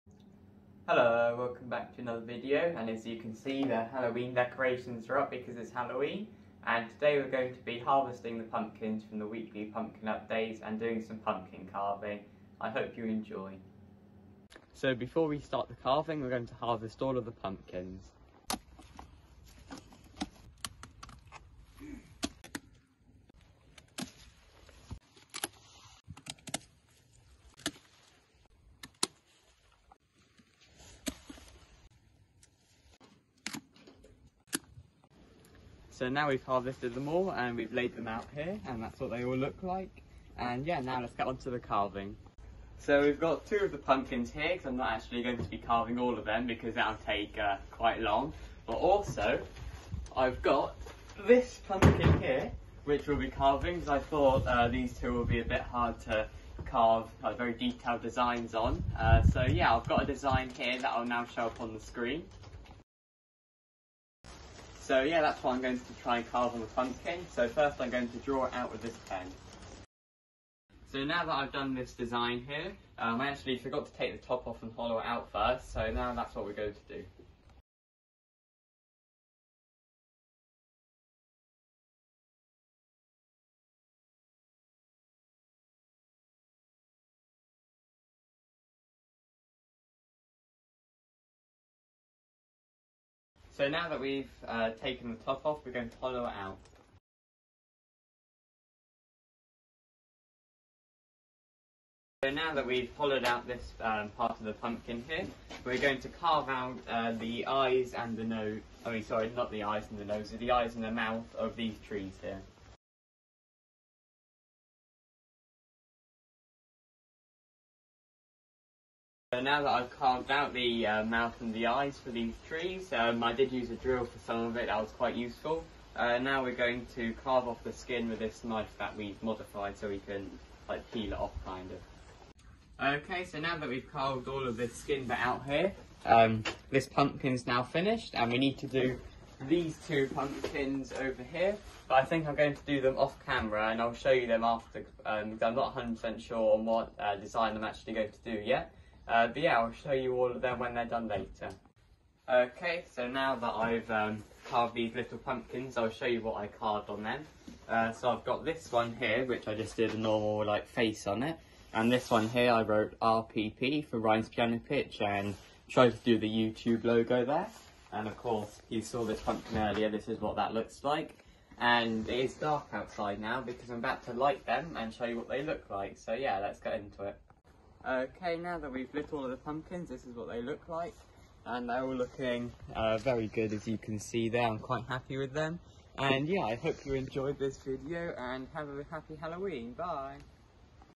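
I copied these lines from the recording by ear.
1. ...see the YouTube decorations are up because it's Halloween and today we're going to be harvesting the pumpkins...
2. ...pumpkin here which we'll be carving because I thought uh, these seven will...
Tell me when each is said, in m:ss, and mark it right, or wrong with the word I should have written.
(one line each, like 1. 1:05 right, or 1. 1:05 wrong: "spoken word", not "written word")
1. 0:03 wrong: "Halloween", not "YouTube"
2. 0:51 wrong: "two", not "seven".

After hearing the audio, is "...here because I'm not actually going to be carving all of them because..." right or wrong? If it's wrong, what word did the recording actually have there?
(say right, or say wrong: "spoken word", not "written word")
right.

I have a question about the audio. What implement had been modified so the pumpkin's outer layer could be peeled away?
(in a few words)
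Knife.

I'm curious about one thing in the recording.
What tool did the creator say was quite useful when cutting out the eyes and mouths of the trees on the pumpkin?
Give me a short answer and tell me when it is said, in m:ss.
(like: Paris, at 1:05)
A drill, at 2:03.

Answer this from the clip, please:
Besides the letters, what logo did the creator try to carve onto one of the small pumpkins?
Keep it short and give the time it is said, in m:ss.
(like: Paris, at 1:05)
YouTube logo, at 2:46.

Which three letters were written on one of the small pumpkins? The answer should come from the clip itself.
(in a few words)
RPP.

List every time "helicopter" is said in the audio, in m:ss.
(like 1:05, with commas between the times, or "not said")
not said.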